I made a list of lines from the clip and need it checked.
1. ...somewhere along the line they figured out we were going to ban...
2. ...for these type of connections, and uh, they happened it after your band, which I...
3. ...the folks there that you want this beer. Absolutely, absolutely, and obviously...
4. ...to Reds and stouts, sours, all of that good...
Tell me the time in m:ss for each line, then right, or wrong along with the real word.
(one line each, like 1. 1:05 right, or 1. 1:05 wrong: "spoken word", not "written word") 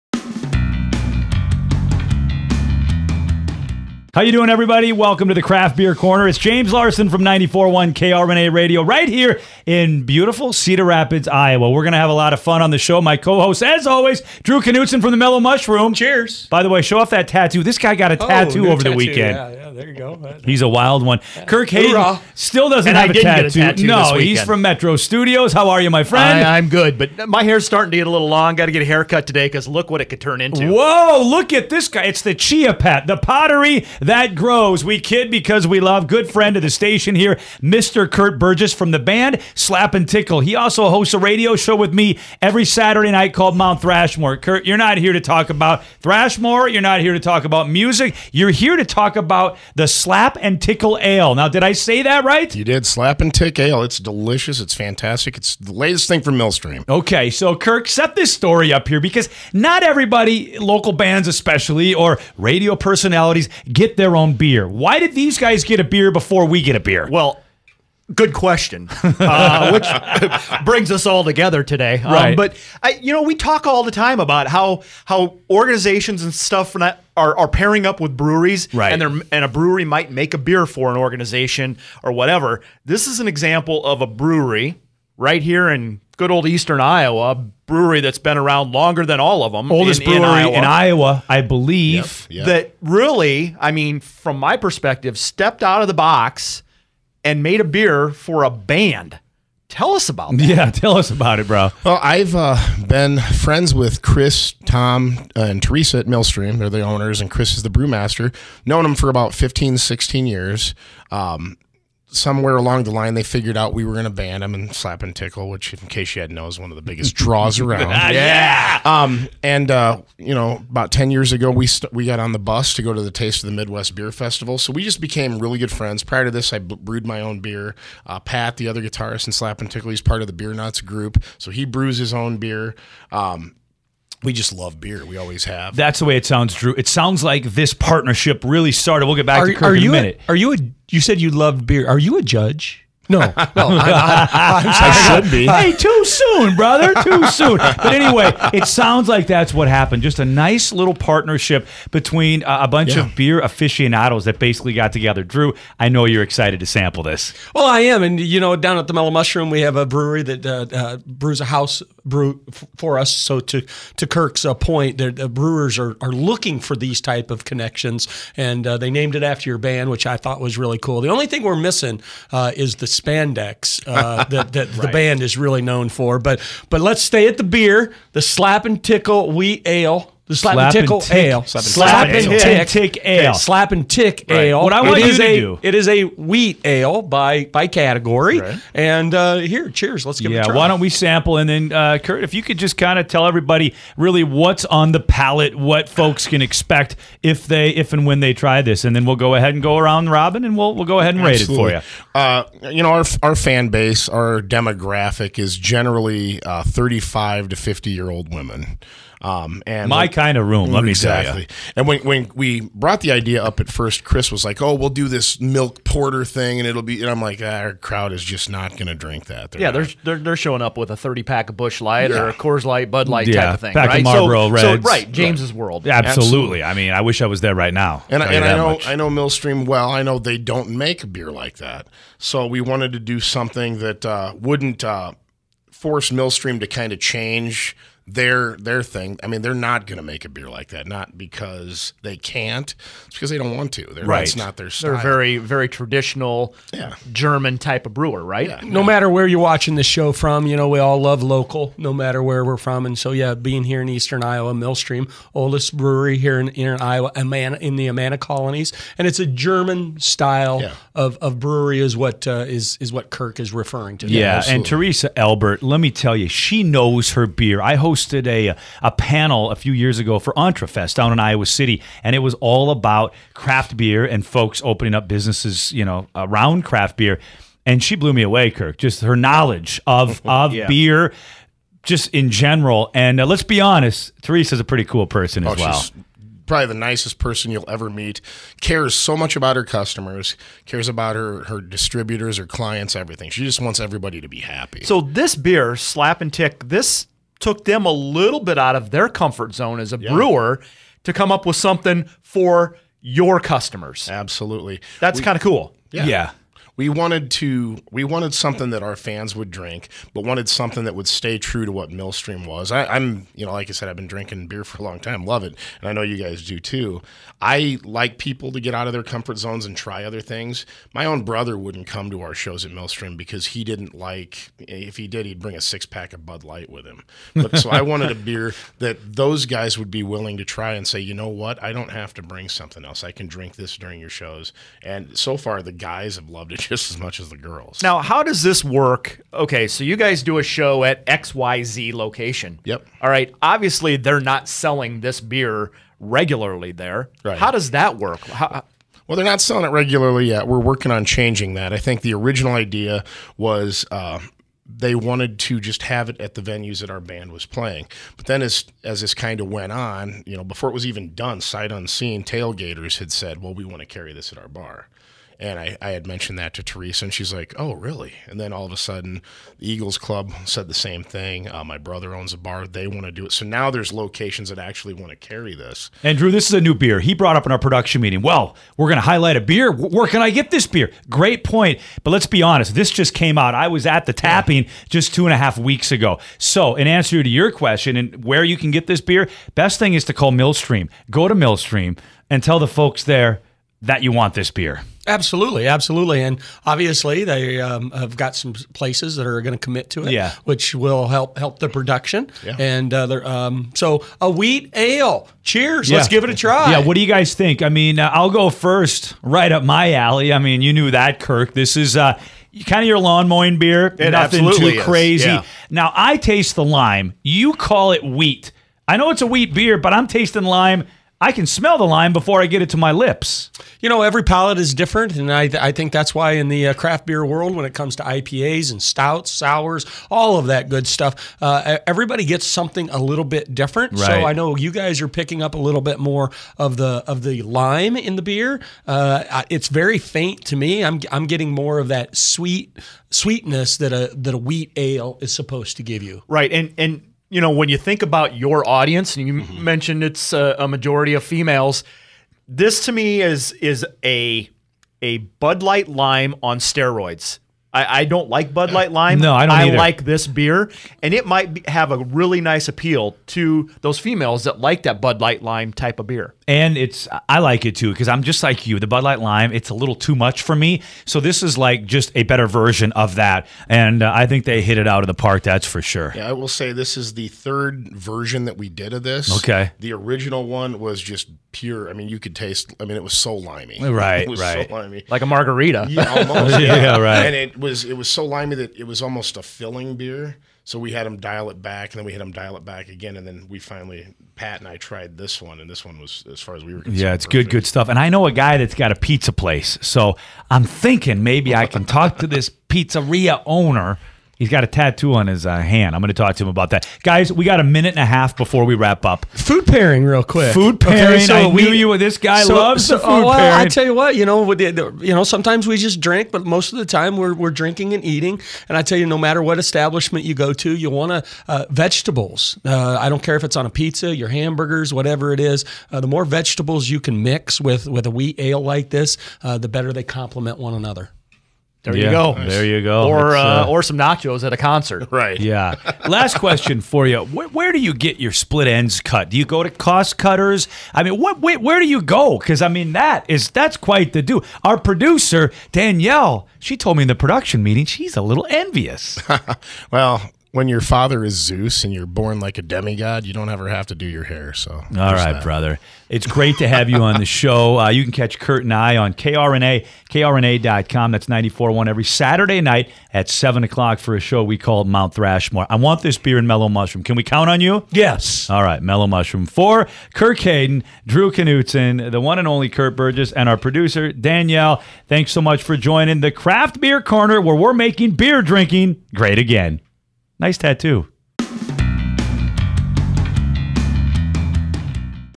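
1. 1:52 right
2. 2:46 wrong: "named", not "happened"
3. 6:32 right
4. 7:07 wrong: "IPAs", not "Reds".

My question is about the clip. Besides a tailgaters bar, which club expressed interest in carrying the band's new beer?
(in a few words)
Eagles Club.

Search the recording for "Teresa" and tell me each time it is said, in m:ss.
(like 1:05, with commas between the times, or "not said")
1:45, 4:24, 4:44, 6:06.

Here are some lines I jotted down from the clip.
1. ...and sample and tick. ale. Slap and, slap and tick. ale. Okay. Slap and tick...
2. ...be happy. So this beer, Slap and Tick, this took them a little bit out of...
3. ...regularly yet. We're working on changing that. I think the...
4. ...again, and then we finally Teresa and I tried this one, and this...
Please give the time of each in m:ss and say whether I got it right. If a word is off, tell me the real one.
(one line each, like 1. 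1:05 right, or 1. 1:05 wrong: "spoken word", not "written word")
1. 3:00 wrong: "tickle", not "sample"
2. 4:54 right
3. 5:49 right
4. 8:12 wrong: "Pat", not "Teresa".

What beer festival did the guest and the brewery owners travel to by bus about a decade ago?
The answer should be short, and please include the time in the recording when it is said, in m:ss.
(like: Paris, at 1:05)
Taste of the Midwest, at 2:03.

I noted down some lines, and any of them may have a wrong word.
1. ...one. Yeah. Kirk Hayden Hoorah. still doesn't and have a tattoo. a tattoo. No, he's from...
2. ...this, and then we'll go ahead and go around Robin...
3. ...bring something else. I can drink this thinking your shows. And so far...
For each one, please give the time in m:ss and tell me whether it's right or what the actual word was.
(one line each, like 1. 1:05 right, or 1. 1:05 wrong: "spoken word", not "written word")
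1. 0:21 right
2. 3:18 right
3. 5:32 wrong: "during", not "thinking".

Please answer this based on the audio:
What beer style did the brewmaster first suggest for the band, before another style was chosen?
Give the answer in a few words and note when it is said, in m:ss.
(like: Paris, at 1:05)
milk porter, at 3:35.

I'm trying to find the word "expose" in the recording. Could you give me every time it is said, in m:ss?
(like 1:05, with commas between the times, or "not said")
not said.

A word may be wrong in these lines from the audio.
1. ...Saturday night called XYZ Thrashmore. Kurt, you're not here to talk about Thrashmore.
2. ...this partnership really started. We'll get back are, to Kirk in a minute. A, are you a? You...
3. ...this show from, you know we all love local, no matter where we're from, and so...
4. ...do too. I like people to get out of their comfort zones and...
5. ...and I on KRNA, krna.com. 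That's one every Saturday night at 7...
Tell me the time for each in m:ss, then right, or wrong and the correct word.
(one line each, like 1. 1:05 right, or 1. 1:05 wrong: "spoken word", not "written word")
1. 0:42 wrong: "Mount", not "XYZ"
2. 2:17 right
3. 4:09 right
4. 5:16 right
5. 9:18 right.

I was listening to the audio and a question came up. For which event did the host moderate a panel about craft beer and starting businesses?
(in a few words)
Entrefest.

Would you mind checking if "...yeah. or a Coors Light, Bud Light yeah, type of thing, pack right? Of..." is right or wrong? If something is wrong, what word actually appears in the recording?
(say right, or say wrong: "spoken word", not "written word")
right.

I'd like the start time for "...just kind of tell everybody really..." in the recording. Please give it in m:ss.
3:12.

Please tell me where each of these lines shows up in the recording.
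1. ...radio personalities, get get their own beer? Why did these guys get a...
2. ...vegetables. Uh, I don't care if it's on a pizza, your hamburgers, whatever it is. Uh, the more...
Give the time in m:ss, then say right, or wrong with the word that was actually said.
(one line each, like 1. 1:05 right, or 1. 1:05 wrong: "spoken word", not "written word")
1. 1:02 right
2. 8:41 right.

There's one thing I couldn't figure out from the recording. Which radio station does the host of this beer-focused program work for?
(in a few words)
94.1 KRNA.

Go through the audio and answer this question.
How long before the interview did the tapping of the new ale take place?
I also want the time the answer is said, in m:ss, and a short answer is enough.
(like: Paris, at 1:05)
two and a half weeks, at 6:25.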